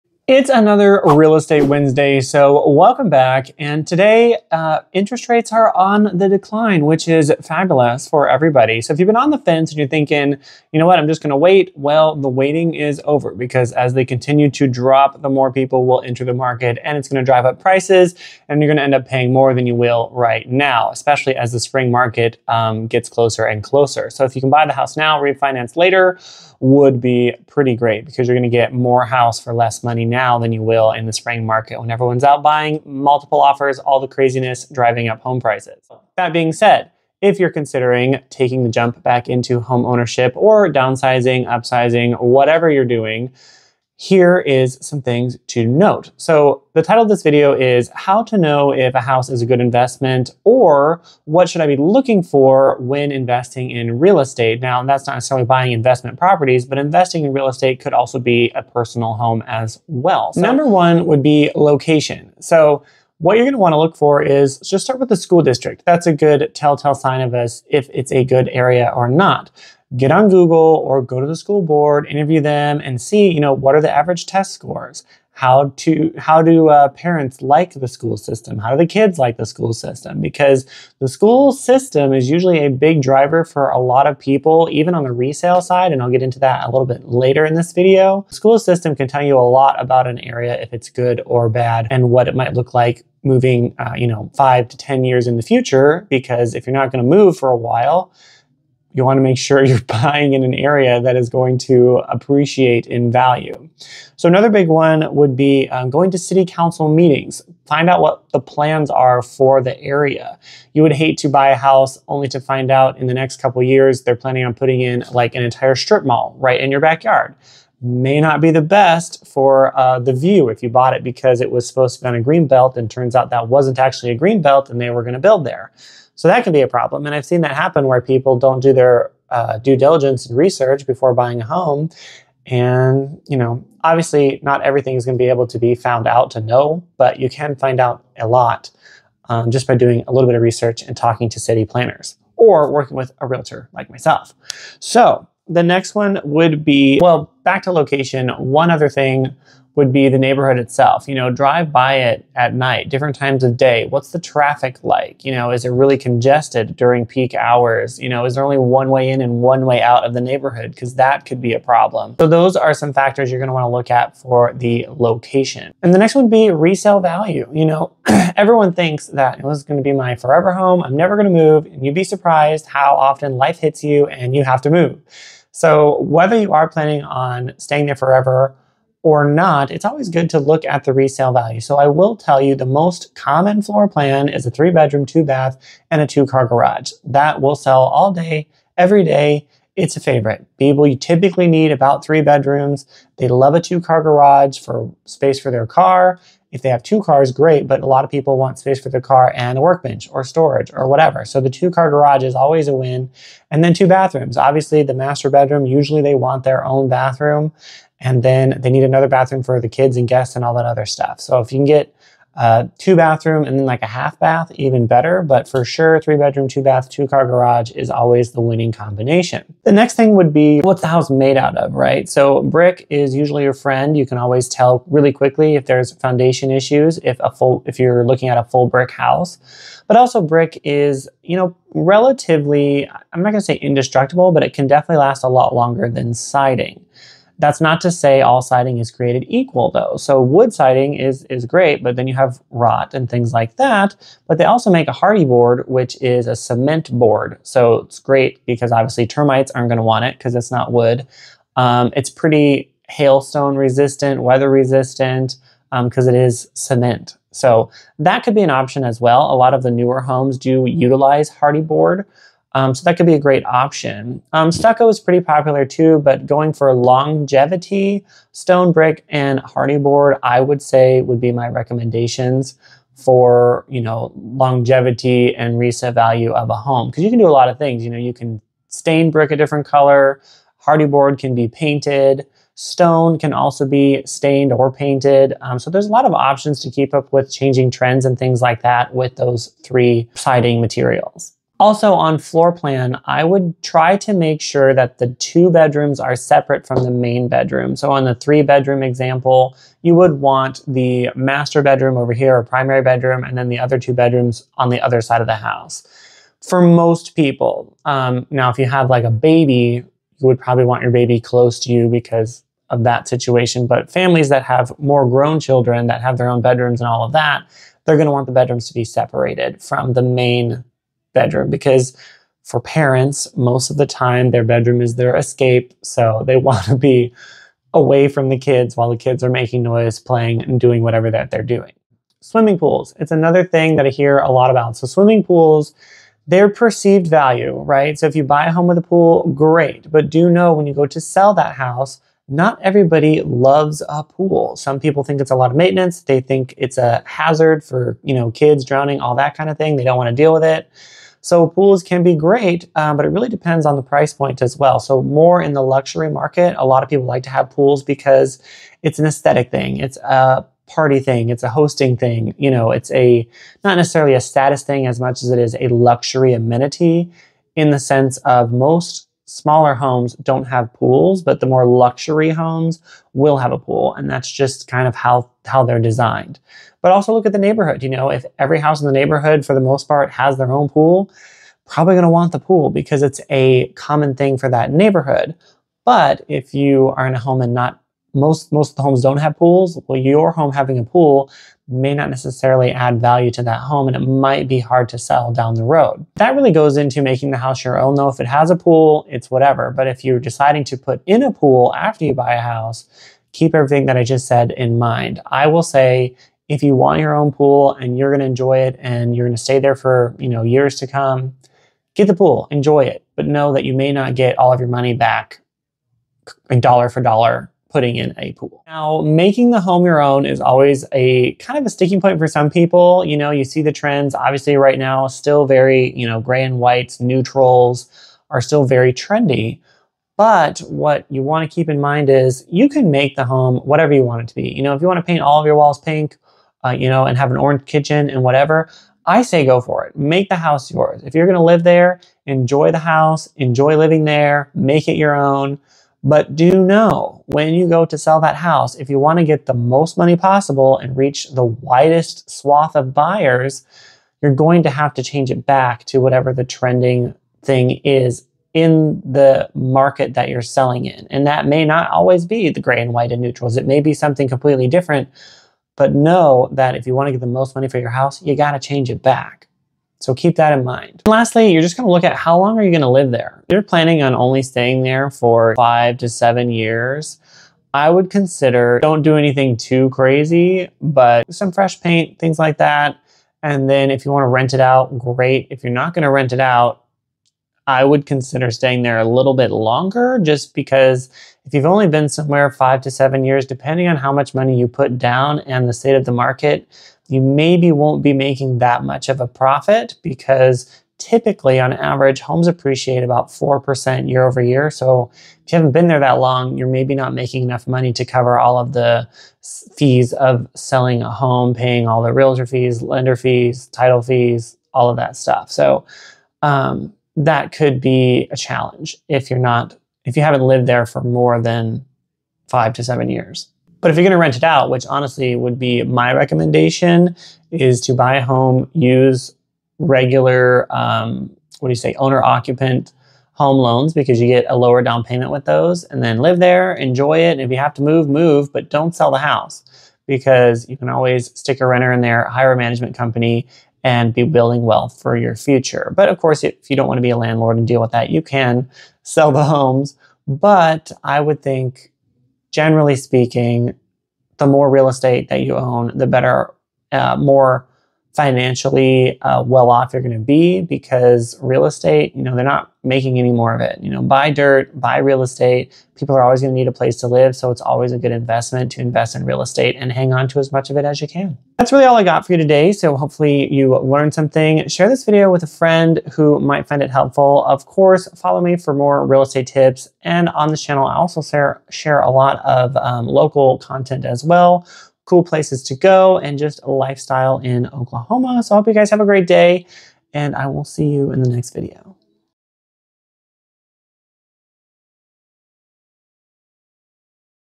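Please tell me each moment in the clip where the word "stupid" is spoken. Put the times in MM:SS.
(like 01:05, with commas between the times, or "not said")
not said.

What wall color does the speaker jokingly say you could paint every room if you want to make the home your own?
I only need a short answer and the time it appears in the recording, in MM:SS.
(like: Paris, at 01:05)
pink, at 07:15.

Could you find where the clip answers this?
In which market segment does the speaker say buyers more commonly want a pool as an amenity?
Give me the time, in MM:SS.
05:55.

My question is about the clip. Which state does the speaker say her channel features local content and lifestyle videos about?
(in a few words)
Oklahoma.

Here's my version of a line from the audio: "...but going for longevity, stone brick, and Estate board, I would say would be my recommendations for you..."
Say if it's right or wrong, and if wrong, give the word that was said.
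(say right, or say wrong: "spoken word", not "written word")
wrong: "Hardie", not "Estate".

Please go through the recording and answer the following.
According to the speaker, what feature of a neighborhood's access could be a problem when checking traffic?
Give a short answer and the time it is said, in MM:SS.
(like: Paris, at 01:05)
one way in and one way out, at 02:38.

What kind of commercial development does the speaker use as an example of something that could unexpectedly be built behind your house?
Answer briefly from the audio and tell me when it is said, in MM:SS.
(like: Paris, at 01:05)
strip mall, at 01:55.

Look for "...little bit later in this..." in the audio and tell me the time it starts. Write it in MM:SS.
01:26.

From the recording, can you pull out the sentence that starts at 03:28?
And then they need another bathroom for the kids and guests and all that other stuff.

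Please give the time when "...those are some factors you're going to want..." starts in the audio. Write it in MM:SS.
02:42.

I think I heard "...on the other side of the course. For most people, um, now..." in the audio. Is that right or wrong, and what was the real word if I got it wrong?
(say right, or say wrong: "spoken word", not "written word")
wrong: "house", not "course".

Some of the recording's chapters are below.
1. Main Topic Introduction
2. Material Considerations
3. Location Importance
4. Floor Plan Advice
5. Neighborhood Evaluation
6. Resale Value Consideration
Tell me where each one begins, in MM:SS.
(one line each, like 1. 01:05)
1. 00:25
2. 03:42
3. 00:56
4. 05:14
5. 02:18
6. 03:15.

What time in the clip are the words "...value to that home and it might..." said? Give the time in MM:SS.
06:32.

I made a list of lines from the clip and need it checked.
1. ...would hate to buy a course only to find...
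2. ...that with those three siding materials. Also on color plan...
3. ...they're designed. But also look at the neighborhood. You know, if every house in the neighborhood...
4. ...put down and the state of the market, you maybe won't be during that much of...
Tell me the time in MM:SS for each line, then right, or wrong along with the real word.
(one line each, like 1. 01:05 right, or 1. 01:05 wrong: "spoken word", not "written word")
1. 01:50 wrong: "house", not "course"
2. 04:48 wrong: "floor", not "color"
3. 06:15 right
4. 08:14 wrong: "making", not "during".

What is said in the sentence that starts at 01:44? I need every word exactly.
So, another big one would be um, going to city council meetings.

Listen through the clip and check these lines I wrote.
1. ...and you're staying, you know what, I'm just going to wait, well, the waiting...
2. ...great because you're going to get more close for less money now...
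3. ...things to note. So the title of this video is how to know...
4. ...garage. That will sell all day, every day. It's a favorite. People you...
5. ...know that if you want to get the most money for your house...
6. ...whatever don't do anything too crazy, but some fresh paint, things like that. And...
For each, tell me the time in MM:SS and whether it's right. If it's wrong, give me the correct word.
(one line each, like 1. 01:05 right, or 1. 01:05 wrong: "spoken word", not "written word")
1. 00:09 wrong: "thinking", not "staying"
2. 00:27 wrong: "house", not "close"
3. 00:44 right
4. 03:06 right
5. 07:45 right
6. 07:58 wrong: "consider", not "whatever".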